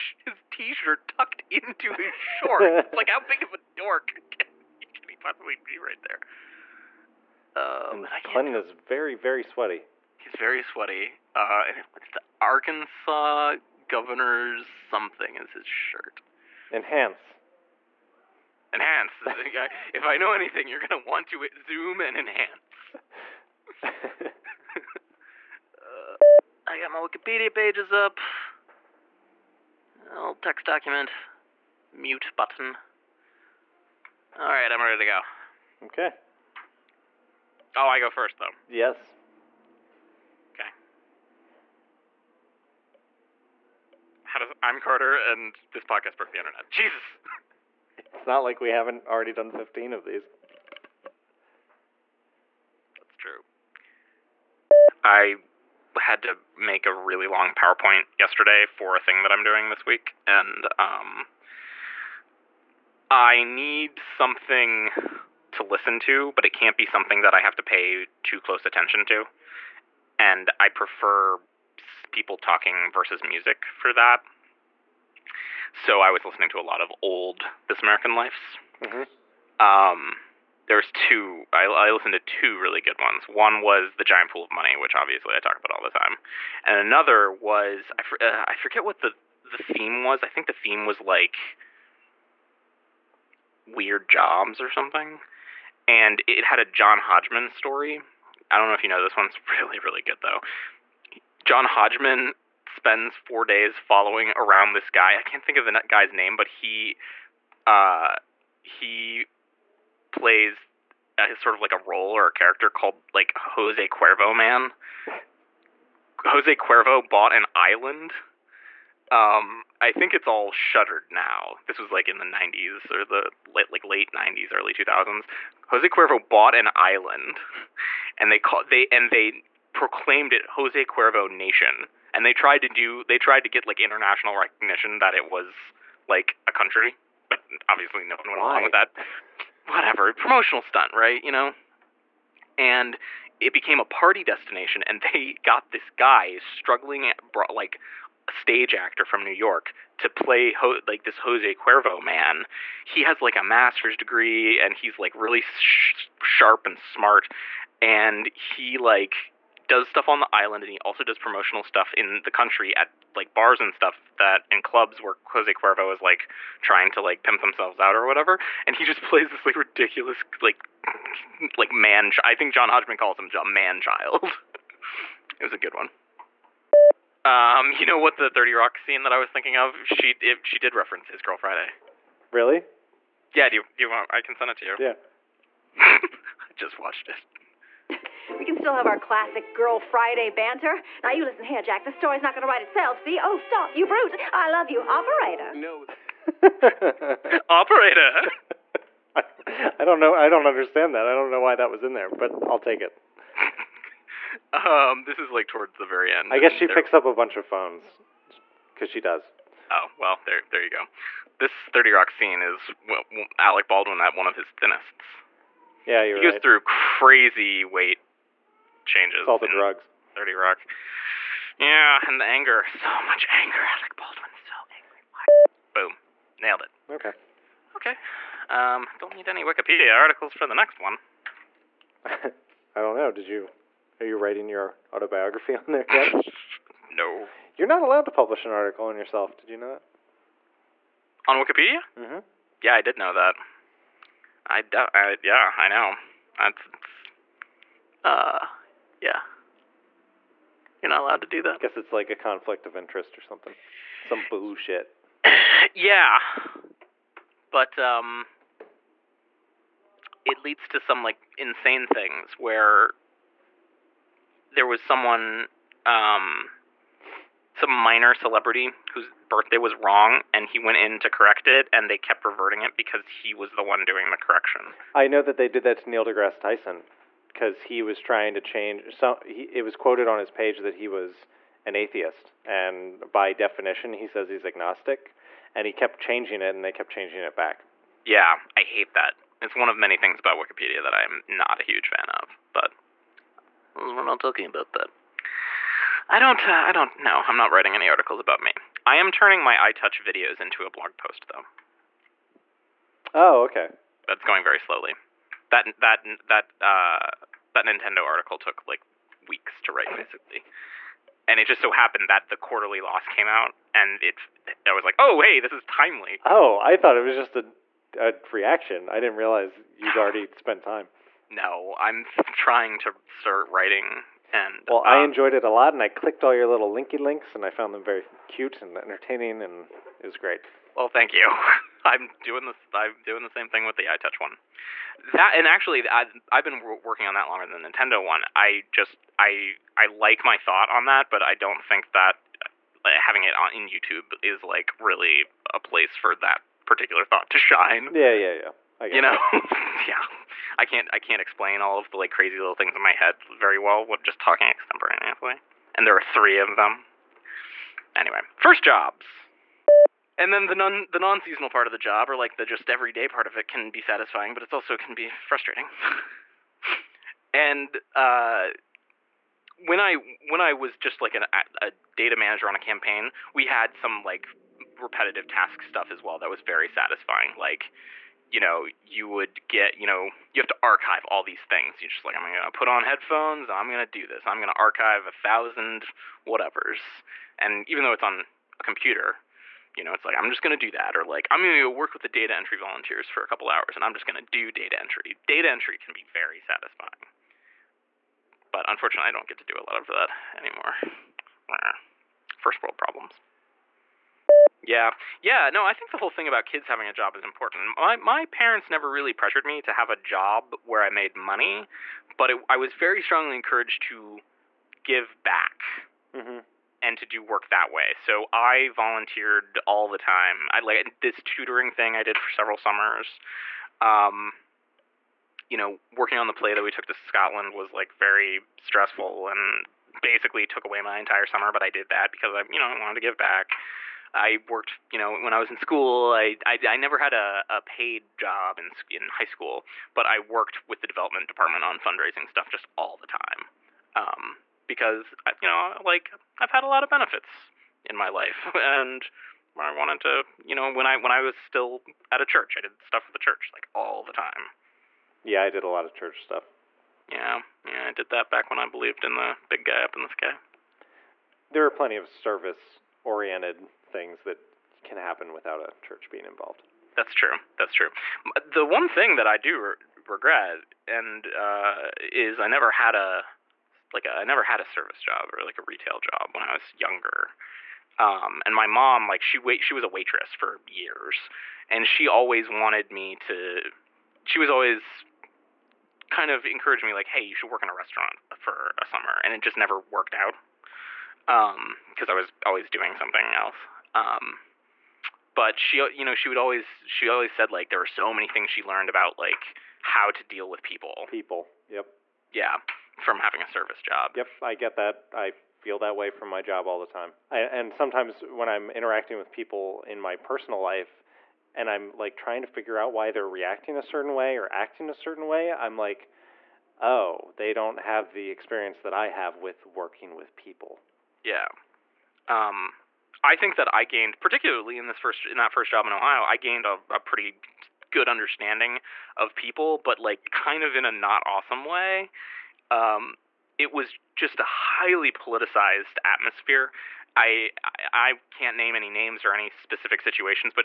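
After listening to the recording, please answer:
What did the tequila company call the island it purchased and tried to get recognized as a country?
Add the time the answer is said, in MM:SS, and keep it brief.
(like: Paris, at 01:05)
Jose Cuervo Nation, at 02:10.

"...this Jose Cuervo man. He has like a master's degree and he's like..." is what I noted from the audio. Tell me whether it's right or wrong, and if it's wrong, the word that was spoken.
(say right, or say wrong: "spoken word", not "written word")
right.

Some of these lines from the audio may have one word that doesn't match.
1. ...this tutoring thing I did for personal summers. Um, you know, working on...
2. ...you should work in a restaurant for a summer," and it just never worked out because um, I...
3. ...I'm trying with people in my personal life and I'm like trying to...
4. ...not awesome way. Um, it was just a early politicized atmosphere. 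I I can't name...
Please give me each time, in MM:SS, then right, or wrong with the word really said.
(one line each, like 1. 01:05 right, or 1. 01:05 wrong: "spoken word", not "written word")
1. 07:00 wrong: "several", not "personal"
2. 08:07 right
3. 08:28 wrong: "interacting", not "trying"
4. 08:50 wrong: "highly", not "early".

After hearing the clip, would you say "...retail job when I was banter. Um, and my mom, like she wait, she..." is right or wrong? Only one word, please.
wrong.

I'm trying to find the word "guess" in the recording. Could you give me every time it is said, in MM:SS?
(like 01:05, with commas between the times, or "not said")
03:26, 04:11.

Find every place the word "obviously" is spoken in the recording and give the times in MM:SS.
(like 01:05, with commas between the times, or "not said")
01:24, 02:17.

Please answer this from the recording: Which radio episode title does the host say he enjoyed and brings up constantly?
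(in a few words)
The Giant Pool of Money.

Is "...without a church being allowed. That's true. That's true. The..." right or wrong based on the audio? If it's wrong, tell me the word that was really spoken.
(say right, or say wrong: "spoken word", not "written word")
wrong: "involved", not "allowed".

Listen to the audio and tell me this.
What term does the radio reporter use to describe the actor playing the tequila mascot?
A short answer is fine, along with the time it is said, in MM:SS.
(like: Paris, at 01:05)
man child, at 02:53.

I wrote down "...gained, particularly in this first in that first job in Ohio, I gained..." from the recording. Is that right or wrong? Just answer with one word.
right.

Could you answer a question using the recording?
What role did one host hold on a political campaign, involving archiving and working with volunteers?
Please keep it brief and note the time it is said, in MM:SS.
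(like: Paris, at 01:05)
data manager, at 06:11.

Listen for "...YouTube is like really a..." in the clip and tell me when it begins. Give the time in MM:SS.
05:43.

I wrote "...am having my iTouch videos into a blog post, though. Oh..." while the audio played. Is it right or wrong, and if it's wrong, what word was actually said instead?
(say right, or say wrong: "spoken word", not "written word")
wrong: "turning", not "having".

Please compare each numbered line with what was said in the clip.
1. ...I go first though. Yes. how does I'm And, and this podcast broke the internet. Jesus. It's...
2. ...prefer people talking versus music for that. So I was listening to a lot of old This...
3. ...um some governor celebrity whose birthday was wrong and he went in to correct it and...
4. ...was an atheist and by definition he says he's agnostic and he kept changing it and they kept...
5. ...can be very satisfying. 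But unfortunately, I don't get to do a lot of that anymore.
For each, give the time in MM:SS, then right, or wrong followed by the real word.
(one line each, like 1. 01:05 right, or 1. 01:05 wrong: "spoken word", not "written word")
1. 00:37 wrong: "Carter", not "And"
2. 01:10 right
3. 04:25 wrong: "minor", not "governor"
4. 04:40 right
5. 06:35 right.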